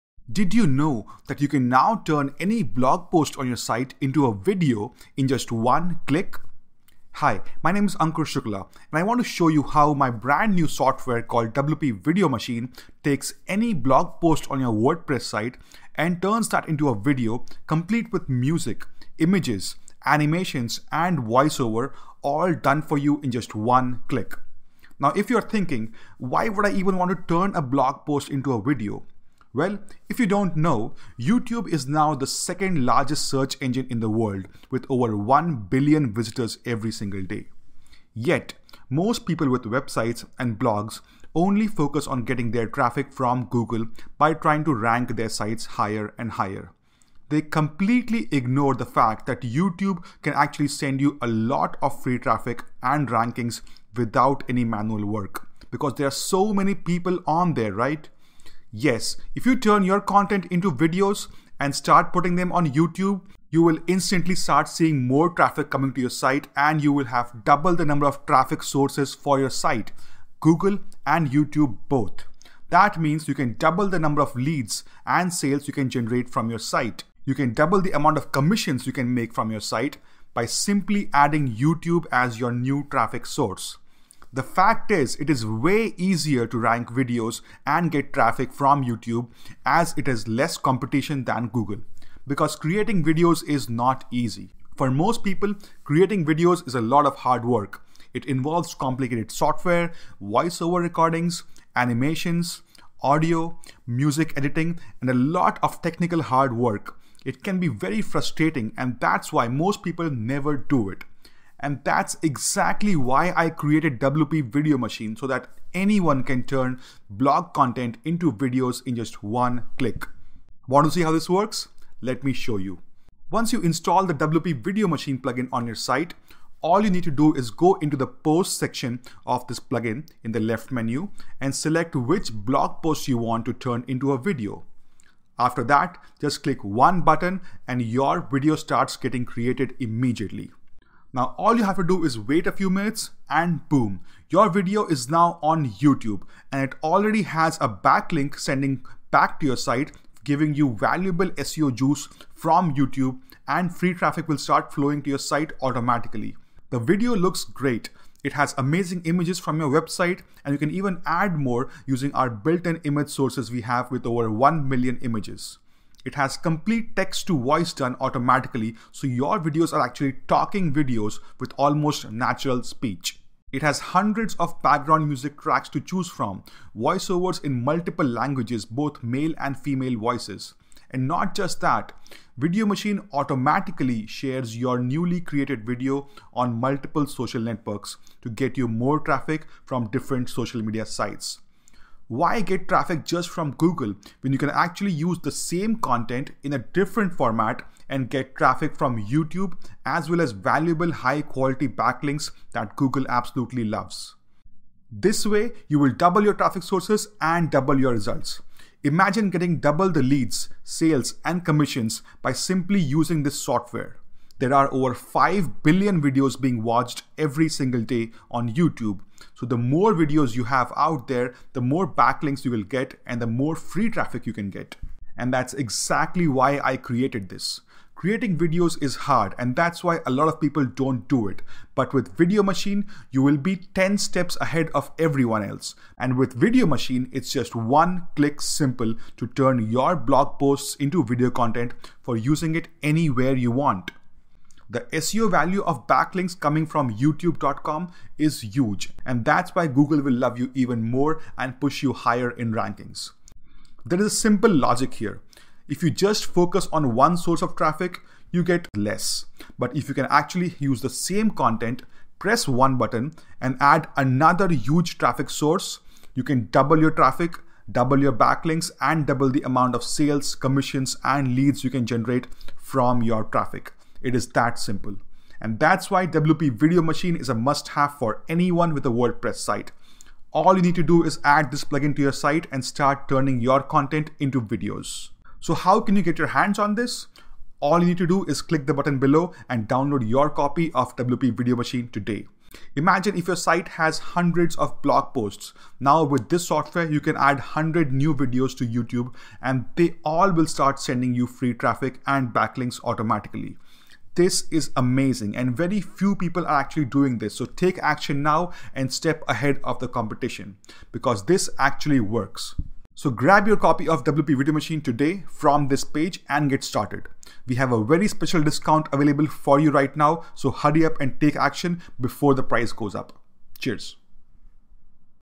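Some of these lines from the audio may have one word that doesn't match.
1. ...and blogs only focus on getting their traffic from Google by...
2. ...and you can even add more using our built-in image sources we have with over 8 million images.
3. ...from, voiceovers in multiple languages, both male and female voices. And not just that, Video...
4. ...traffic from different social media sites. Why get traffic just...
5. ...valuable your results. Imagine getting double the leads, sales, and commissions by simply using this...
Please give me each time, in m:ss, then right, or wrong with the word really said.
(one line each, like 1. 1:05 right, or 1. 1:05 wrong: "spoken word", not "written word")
1. 0:40 right
2. 2:40 wrong: "1", not "8"
3. 2:56 right
4. 3:08 right
5. 3:27 wrong: "double", not "valuable".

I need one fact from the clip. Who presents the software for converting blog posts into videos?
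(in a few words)
Ankur Shukla.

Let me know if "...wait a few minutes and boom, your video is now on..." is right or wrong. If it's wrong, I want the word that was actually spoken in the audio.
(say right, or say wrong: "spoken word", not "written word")
right.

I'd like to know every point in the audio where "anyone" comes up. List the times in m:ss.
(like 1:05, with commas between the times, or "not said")
1:55, 4:38.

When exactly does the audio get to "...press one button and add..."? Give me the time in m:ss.
4:22.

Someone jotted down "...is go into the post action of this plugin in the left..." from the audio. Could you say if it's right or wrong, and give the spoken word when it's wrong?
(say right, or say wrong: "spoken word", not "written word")
wrong: "section", not "action".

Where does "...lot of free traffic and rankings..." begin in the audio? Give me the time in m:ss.
0:51.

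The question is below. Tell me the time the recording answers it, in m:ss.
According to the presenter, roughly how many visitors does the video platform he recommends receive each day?
0:34.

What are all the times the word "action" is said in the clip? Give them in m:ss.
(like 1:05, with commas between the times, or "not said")
5:07, 5:21.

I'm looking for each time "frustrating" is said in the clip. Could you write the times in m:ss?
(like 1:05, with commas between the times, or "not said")
1:48.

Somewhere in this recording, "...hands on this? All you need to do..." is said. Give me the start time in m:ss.
4:46.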